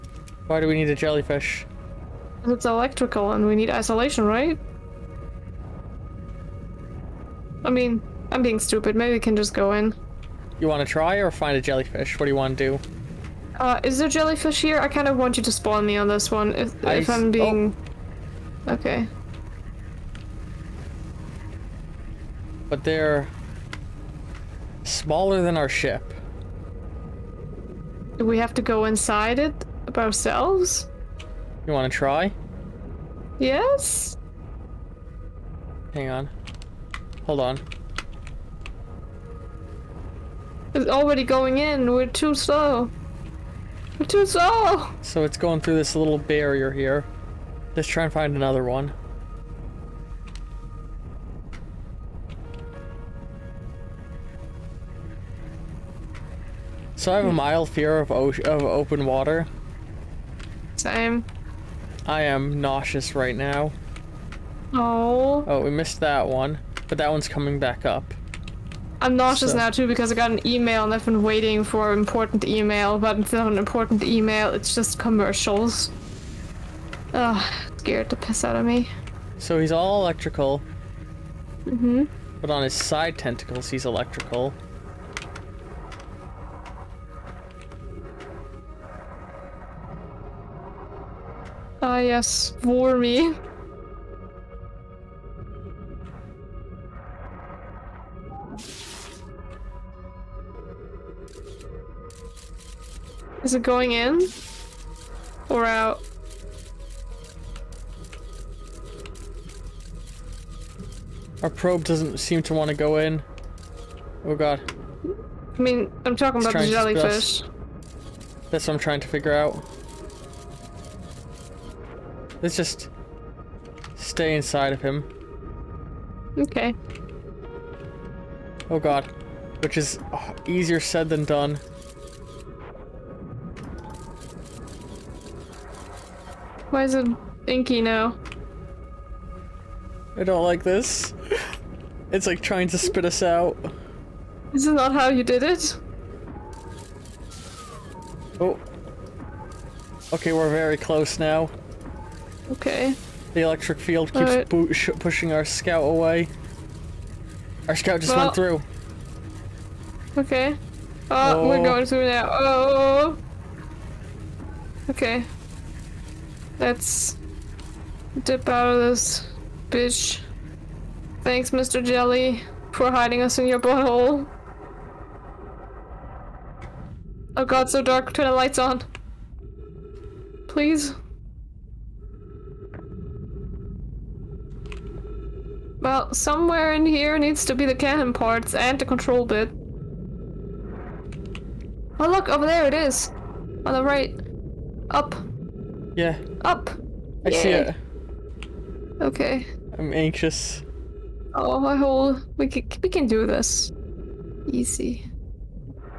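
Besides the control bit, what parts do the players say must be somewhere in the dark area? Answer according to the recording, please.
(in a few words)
Cannon parts.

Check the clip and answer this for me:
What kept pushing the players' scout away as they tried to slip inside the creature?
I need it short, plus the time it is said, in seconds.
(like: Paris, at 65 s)
The electric field, at 153 s.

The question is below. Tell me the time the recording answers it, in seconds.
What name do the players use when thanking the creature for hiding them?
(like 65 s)
171 s.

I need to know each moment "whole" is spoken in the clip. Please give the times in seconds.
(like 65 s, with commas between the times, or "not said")
201 s.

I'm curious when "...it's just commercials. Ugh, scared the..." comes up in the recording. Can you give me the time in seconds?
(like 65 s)
74 s.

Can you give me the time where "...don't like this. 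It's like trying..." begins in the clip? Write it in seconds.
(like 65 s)
140 s.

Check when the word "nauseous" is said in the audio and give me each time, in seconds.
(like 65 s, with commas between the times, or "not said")
62 s, 69 s.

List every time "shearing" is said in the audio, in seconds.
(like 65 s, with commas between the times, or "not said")
not said.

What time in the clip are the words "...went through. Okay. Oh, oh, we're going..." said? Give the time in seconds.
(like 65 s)
158 s.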